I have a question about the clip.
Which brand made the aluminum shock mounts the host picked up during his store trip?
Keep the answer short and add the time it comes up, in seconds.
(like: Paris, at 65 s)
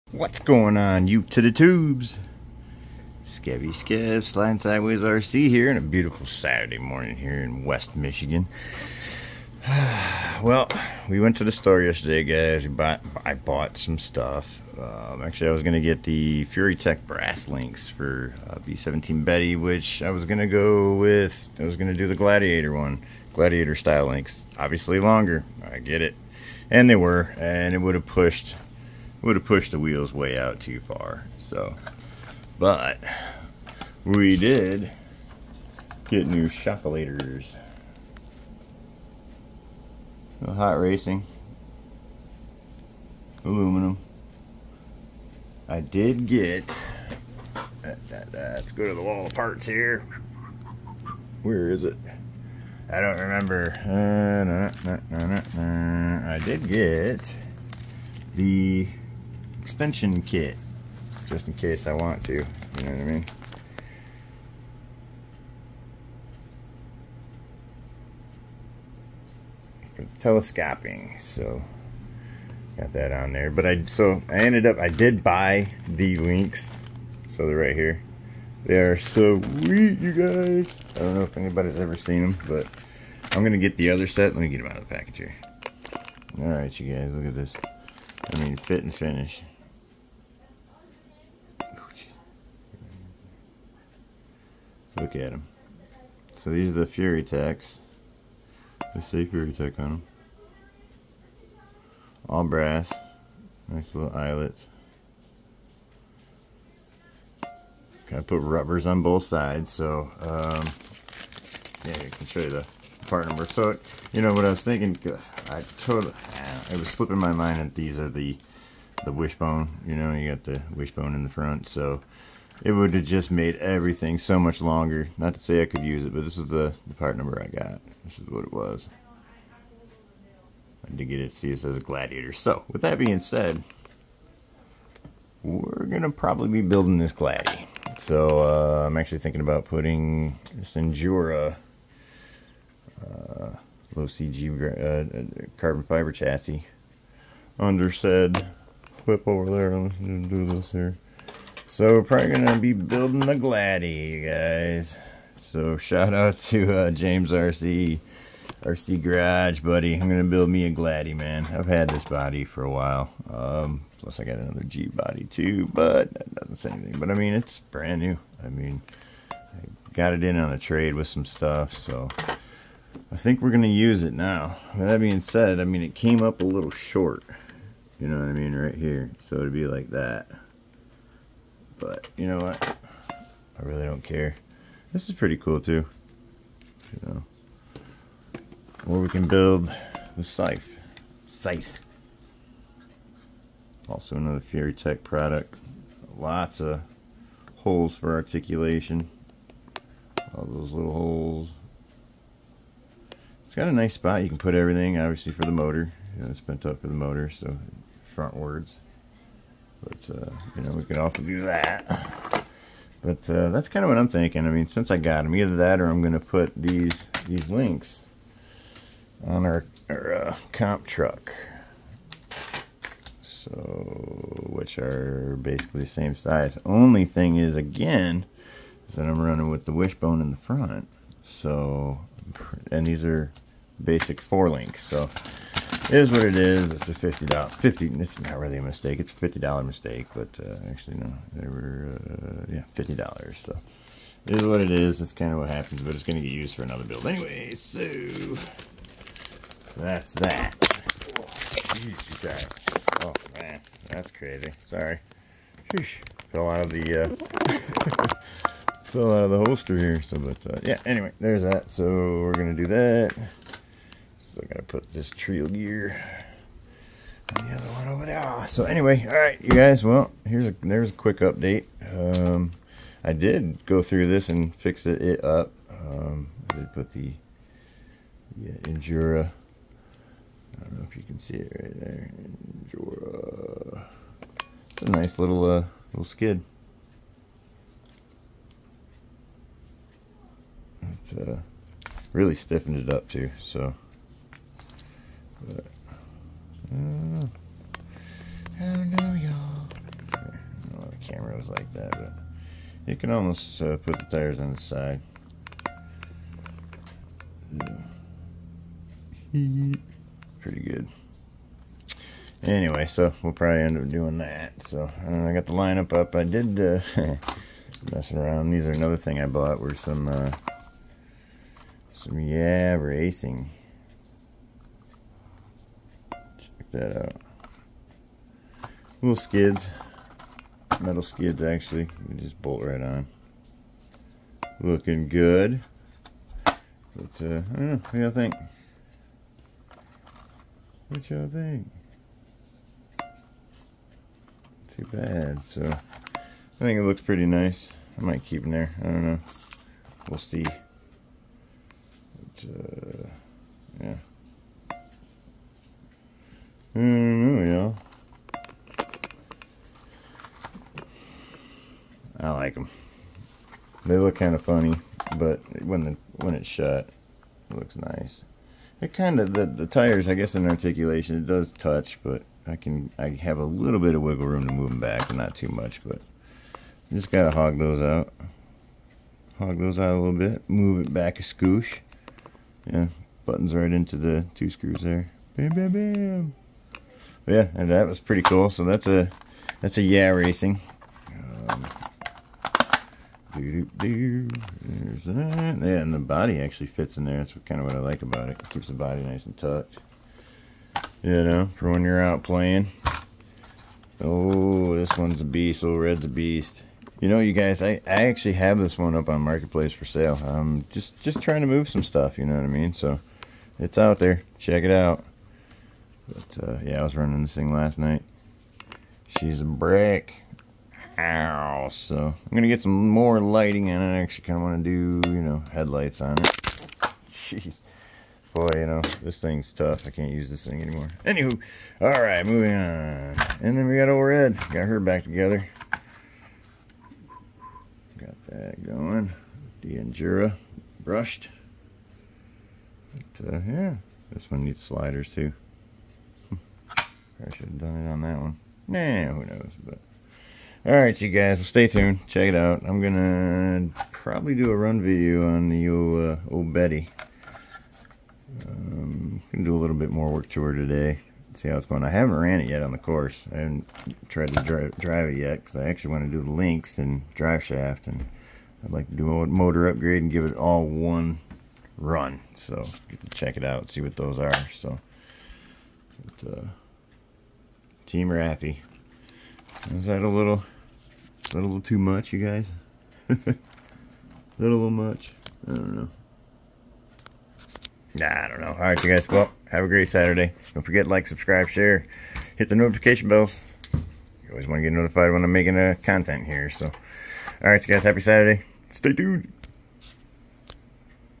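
Hot Racing, at 40 s.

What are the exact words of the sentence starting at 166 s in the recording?
But I mean, it's brand new.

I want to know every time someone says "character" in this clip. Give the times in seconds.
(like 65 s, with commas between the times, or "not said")
not said.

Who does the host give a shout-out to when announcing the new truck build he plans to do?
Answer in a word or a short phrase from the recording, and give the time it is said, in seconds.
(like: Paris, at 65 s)
James RC, at 156 s.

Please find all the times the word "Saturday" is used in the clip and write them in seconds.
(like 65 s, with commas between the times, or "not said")
6 s, 489 s, 497 s.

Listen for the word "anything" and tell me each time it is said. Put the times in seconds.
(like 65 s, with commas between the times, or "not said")
166 s.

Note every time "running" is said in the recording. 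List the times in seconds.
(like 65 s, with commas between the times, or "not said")
229 s, 416 s.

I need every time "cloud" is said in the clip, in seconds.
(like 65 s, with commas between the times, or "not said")
not said.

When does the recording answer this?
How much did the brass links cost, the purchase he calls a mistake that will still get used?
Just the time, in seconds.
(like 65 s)
242 s.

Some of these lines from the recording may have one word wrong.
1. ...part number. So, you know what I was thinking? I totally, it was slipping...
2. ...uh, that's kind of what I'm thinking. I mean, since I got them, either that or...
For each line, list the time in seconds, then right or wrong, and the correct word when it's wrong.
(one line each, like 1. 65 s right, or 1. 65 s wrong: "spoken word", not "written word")
1. 113 s right
2. 213 s right.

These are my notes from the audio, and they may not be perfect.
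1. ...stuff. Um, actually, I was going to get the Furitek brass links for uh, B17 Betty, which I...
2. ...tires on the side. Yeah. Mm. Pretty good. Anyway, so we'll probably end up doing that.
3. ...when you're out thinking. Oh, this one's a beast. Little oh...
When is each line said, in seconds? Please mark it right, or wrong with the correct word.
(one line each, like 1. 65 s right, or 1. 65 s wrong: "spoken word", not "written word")
1. 13 s right
2. 304 s right
3. 401 s wrong: "playing", not "thinking".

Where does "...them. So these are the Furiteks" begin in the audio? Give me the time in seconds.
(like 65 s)
95 s.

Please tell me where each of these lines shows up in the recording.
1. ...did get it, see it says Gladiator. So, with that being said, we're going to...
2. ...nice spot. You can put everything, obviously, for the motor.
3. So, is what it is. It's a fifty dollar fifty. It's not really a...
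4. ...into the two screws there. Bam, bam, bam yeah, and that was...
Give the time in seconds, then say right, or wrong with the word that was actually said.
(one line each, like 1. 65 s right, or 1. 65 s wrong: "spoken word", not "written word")
1. 130 s right
2. 203 s right
3. 234 s right
4. 383 s right.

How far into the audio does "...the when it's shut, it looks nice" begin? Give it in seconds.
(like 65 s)
365 s.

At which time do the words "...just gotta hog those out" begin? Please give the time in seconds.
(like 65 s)
376 s.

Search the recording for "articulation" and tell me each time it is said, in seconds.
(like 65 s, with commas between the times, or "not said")
198 s, 370 s.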